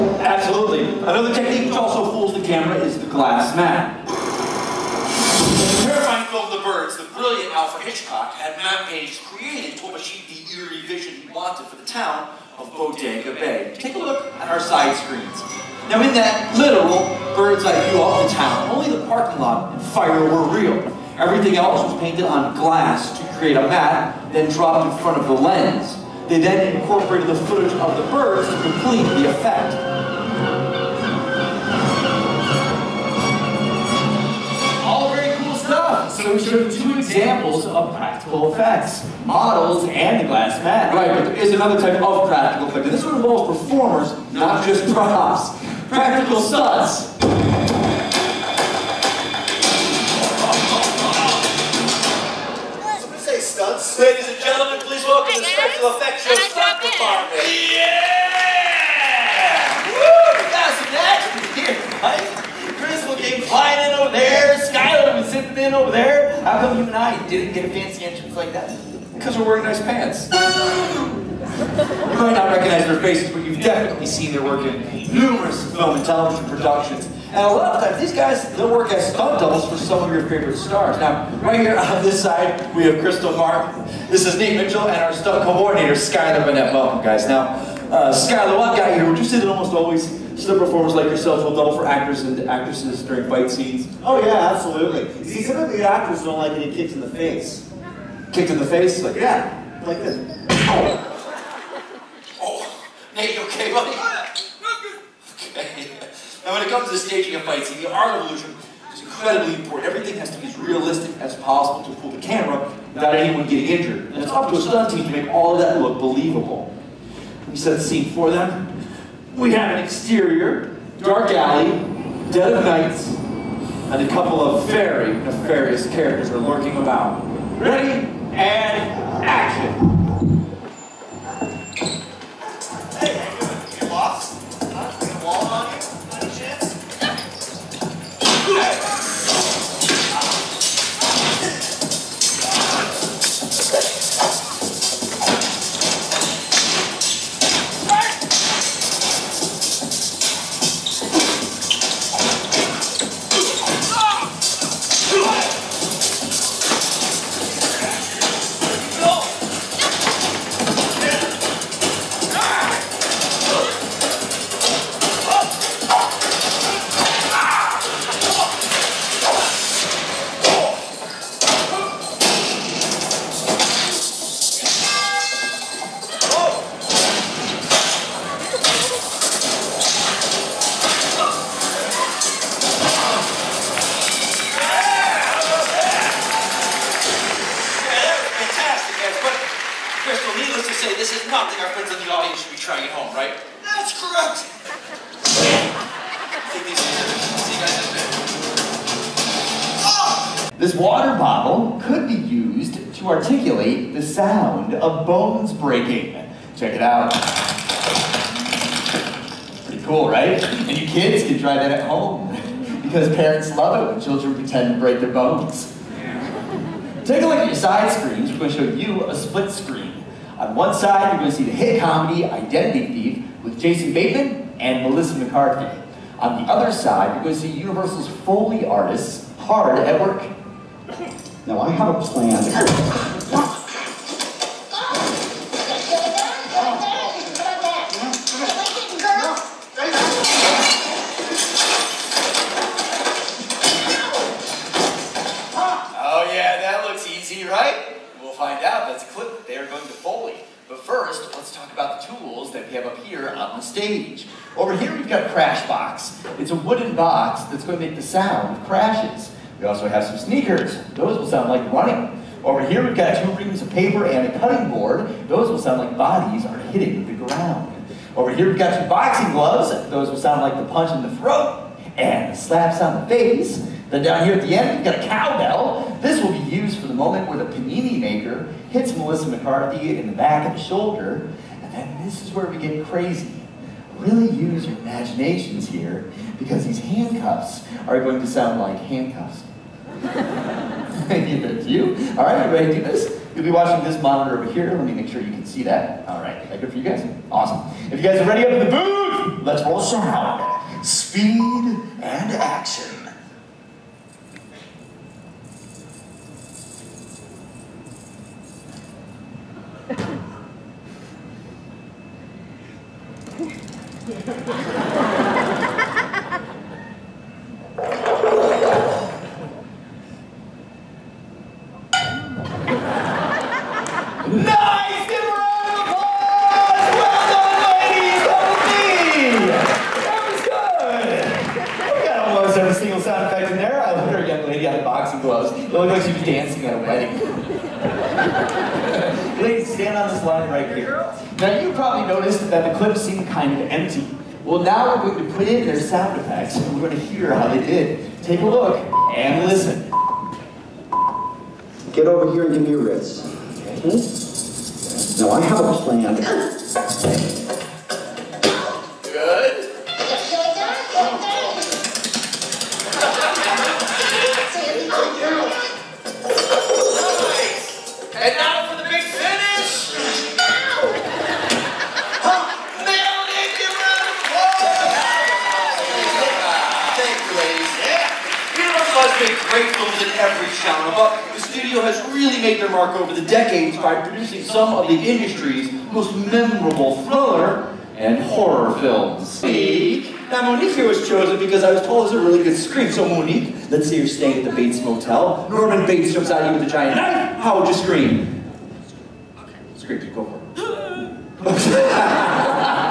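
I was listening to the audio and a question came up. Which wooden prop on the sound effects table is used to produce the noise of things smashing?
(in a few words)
crash box.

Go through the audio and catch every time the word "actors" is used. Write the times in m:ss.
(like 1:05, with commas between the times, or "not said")
1:31, 1:35.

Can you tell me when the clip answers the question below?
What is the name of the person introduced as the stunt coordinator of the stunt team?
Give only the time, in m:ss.
1:25.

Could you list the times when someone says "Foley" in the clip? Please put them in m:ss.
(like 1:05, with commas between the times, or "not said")
3:48, 4:09.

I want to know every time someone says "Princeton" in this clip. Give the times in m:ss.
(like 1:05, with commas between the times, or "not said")
not said.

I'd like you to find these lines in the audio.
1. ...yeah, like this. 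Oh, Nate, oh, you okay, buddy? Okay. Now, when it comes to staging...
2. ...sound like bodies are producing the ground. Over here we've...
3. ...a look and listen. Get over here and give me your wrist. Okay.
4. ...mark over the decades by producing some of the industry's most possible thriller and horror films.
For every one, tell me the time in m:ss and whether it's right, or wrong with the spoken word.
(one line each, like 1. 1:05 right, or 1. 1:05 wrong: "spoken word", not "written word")
1. 1:39 right
2. 4:25 wrong: "hitting", not "producing"
3. 5:48 right
4. 6:22 wrong: "memorable", not "possible".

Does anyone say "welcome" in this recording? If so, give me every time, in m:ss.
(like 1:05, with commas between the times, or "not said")
0:55, 1:26.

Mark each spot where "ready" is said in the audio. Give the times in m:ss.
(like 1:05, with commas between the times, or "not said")
2:07, 4:58.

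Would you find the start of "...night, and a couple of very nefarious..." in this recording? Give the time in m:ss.
2:02.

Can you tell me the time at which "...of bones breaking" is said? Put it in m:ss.
3:24.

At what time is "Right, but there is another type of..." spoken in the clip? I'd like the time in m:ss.
0:40.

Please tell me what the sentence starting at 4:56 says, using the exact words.
All right, good for you guys?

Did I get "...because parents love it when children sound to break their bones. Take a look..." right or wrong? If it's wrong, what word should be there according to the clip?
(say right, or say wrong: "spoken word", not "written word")
wrong: "pretend", not "sound".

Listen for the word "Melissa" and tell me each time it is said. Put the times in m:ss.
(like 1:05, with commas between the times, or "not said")
3:44, 4:38.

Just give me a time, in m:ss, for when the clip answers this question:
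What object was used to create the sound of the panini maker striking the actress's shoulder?
4:35.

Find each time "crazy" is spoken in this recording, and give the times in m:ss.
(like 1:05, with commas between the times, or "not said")
4:42.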